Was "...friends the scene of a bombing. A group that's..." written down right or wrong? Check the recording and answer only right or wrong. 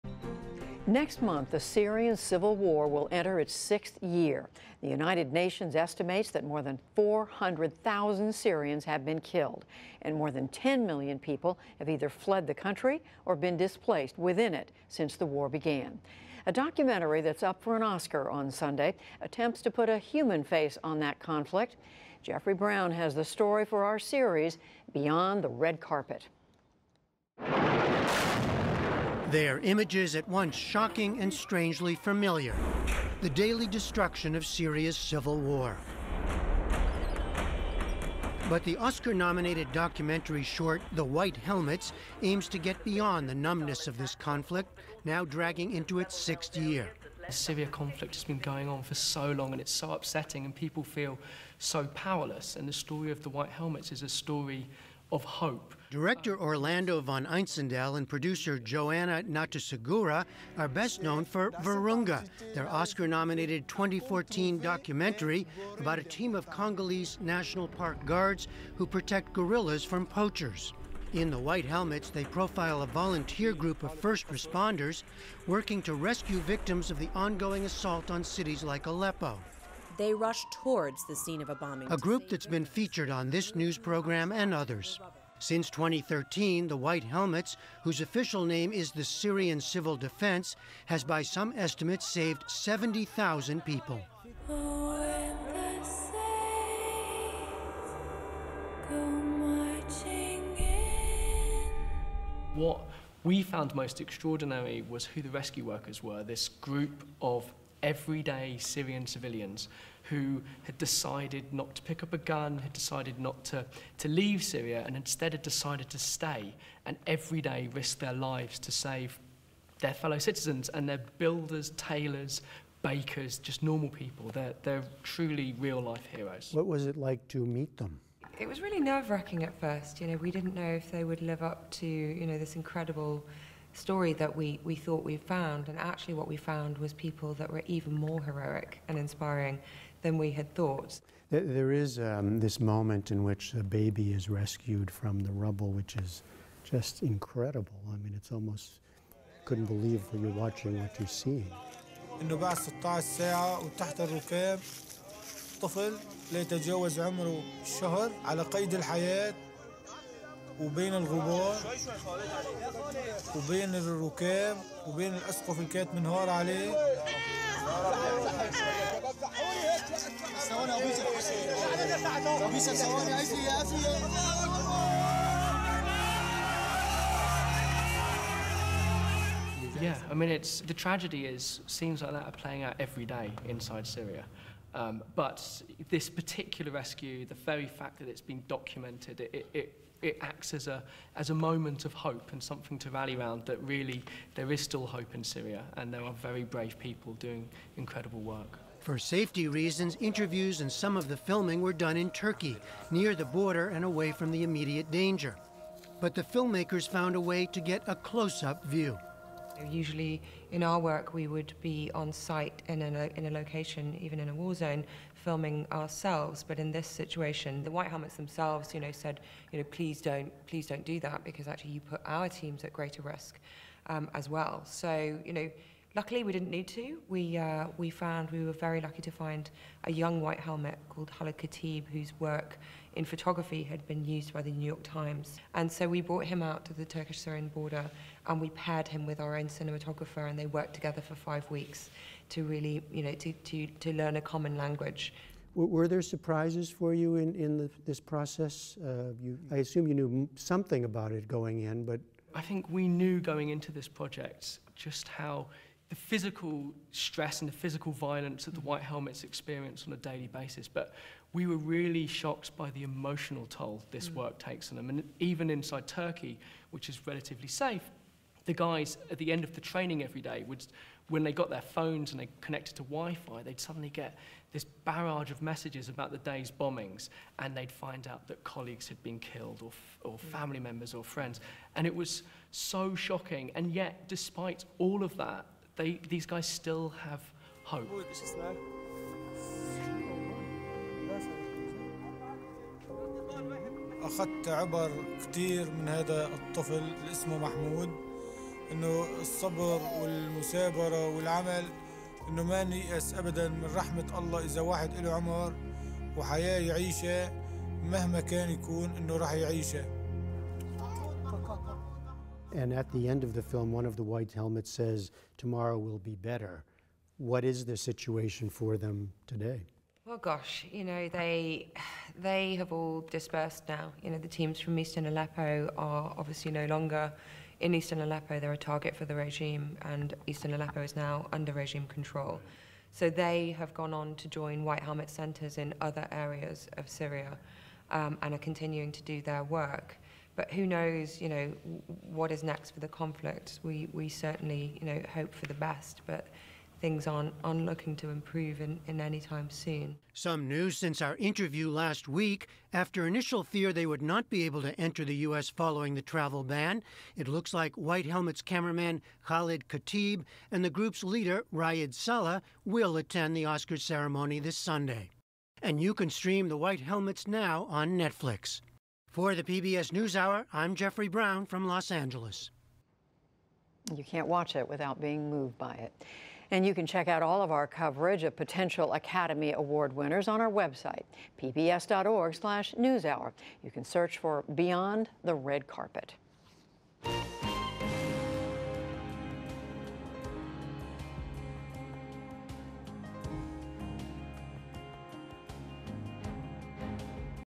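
wrong.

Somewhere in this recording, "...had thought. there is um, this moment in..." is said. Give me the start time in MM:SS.
02:20.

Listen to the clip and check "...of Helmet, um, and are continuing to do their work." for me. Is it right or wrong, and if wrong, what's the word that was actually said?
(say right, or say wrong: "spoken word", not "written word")
wrong: "Syria", not "Helmet".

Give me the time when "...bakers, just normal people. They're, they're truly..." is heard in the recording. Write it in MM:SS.
02:02.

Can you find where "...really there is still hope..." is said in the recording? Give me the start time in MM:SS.
03:13.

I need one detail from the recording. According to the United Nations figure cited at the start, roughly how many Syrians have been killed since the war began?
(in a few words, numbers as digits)
more than 400,000.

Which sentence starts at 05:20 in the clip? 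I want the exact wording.
Well, gosh, you know they they have all dispersed now.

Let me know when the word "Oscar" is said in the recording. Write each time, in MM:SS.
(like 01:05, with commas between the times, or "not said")
00:17, 00:38, 01:02, 06:03.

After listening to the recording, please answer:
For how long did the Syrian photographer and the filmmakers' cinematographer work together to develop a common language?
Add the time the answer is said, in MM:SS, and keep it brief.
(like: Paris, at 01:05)
5 weeks, at 04:01.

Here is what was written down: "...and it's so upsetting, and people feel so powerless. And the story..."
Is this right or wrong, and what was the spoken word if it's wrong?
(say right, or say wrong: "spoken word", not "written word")
right.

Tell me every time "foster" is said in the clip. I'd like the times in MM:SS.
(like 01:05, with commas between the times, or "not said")
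not said.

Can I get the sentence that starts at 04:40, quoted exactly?
family members, or friends, and it was so shocking.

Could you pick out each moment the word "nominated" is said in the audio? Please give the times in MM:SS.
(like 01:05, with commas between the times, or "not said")
00:39, 01:03.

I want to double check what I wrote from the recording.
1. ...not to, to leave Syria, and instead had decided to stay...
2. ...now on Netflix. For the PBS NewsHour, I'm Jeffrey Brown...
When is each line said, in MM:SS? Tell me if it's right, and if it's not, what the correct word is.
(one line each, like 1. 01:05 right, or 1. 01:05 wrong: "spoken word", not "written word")
1. 01:53 right
2. 06:07 right.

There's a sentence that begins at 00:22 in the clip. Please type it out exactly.
Jeffrey Brown has the story for our series, Beyond the Red Carpet.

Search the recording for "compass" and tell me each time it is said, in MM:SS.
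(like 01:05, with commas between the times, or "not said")
not said.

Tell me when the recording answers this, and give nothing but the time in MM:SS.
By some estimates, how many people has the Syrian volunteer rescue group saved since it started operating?
01:32.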